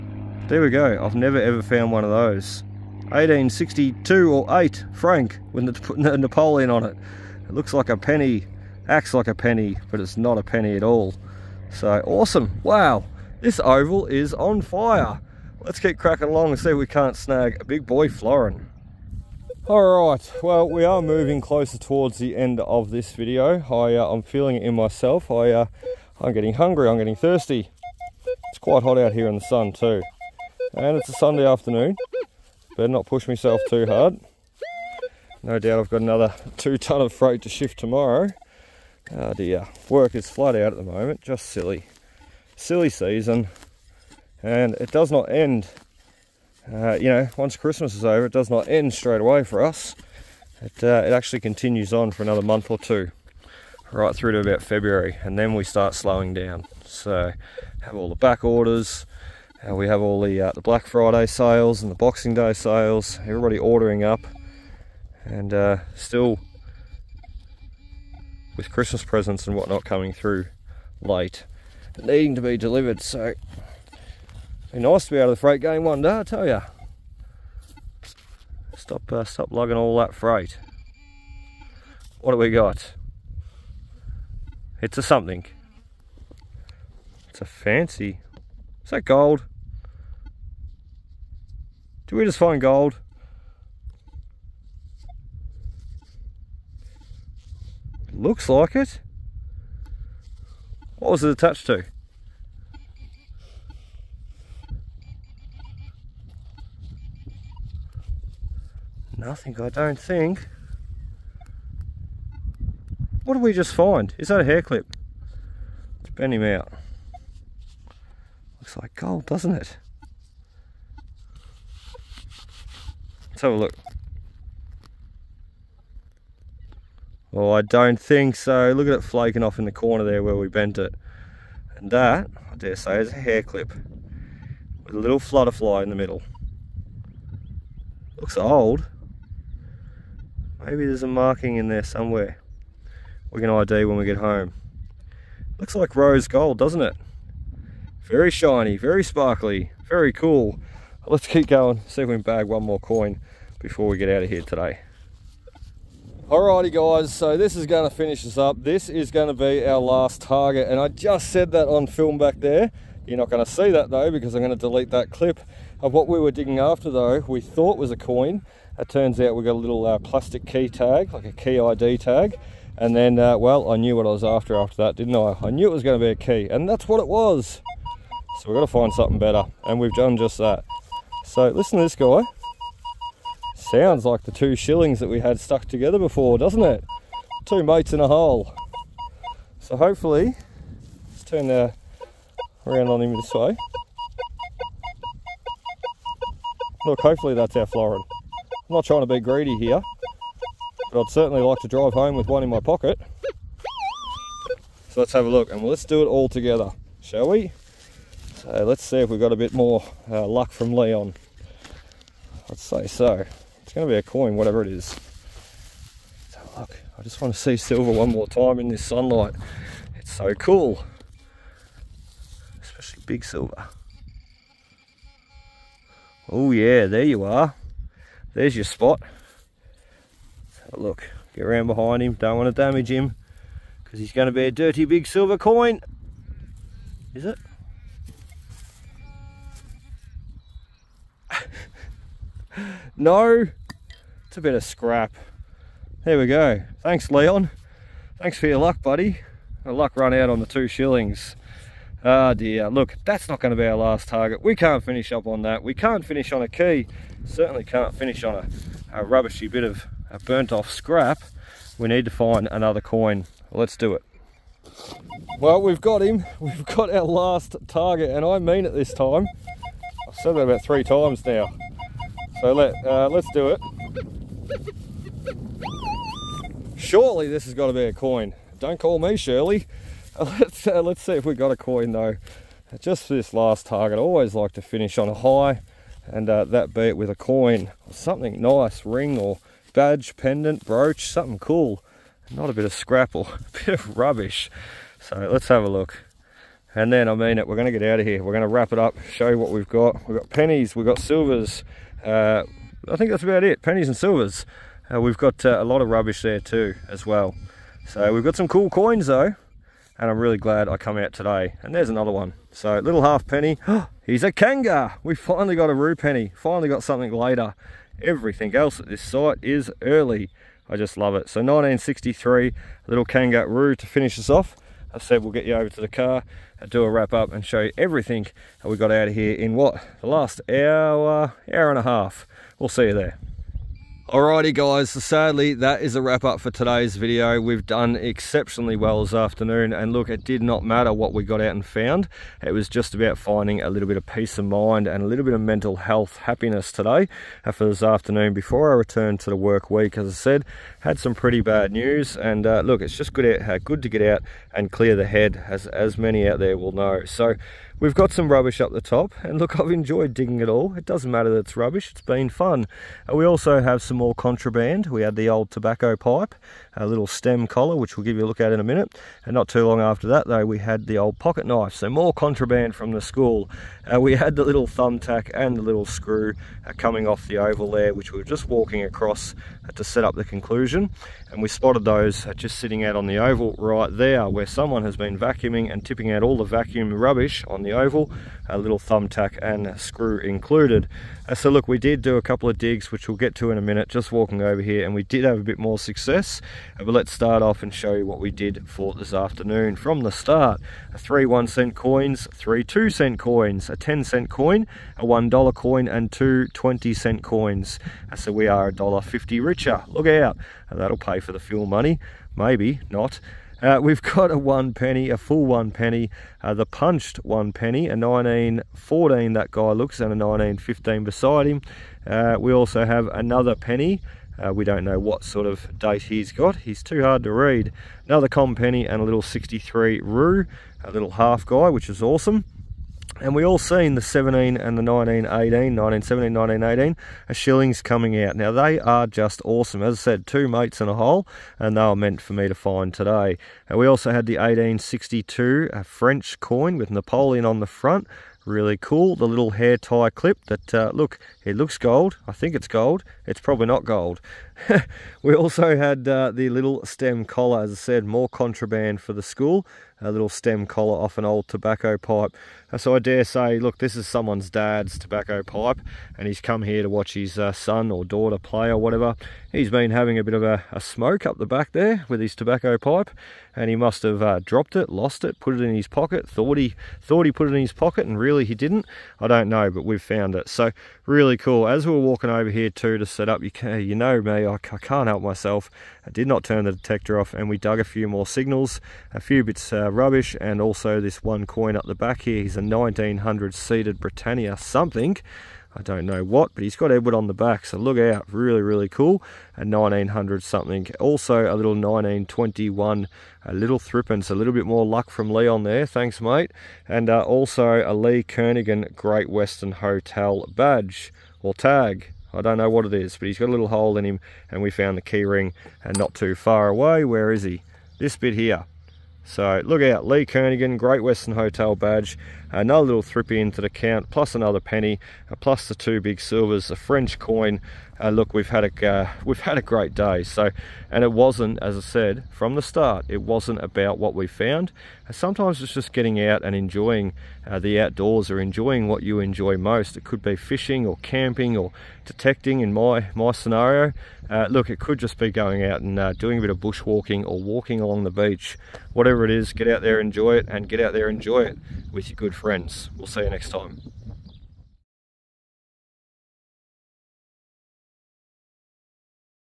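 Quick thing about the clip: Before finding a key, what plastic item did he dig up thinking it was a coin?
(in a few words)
key ID tag.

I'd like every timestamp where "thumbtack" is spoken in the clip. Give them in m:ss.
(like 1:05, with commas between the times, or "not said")
6:14, 6:28.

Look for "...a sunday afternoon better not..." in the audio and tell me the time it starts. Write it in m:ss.
0:31.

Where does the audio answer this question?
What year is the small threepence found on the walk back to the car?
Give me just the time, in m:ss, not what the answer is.
8:21.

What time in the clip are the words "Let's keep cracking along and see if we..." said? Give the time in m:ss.
0:15.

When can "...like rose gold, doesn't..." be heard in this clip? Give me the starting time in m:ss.
2:25.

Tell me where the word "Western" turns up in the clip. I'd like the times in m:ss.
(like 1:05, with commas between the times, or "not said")
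8:29, 8:41.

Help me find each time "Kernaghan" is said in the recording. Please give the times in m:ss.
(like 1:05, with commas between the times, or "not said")
8:28, 8:40.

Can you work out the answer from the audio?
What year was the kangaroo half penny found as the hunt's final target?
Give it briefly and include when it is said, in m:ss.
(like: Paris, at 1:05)
1963, at 5:21.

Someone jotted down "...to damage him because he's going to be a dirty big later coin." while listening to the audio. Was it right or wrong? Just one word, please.
wrong.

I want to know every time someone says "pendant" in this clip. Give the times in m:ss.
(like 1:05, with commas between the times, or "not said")
4:50.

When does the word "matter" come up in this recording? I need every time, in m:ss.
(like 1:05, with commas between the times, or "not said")
5:40, 6:01.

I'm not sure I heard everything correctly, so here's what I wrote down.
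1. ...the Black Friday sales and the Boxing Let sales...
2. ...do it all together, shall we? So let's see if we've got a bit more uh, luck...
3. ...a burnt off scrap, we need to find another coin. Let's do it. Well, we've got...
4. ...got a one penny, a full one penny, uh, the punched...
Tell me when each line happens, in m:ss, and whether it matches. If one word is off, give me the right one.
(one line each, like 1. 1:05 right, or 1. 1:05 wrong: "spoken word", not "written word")
1. 1:00 wrong: "Day", not "Let"
2. 3:25 right
3. 4:20 right
4. 6:54 right.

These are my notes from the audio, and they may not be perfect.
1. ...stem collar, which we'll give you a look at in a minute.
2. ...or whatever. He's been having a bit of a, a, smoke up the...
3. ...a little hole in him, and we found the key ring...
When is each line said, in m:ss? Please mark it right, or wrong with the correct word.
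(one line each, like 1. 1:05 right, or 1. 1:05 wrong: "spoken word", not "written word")
1. 6:07 right
2. 7:48 right
3. 8:33 right.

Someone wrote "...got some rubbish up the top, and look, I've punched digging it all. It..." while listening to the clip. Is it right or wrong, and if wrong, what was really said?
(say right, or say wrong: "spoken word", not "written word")
wrong: "enjoyed", not "punched".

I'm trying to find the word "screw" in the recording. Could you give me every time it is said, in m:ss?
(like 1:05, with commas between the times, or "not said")
6:15, 6:29.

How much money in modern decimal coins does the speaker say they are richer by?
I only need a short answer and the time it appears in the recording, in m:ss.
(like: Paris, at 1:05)
$1.50, at 6:48.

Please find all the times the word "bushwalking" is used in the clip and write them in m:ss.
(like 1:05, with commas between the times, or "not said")
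9:06.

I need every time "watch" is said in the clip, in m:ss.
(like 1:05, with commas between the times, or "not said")
7:46.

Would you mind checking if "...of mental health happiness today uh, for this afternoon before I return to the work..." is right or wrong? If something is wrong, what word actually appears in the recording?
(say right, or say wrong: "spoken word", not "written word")
right.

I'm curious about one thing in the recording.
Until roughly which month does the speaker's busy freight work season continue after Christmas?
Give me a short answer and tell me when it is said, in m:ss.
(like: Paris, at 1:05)
February, at 0:54.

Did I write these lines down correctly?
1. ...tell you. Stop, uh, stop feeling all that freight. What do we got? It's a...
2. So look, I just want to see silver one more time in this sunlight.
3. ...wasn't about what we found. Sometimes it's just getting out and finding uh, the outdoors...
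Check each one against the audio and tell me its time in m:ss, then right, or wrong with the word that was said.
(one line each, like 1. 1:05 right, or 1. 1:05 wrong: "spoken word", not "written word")
1. 1:16 wrong: "lugging", not "feeling"
2. 3:36 right
3. 8:53 wrong: "enjoying", not "finding".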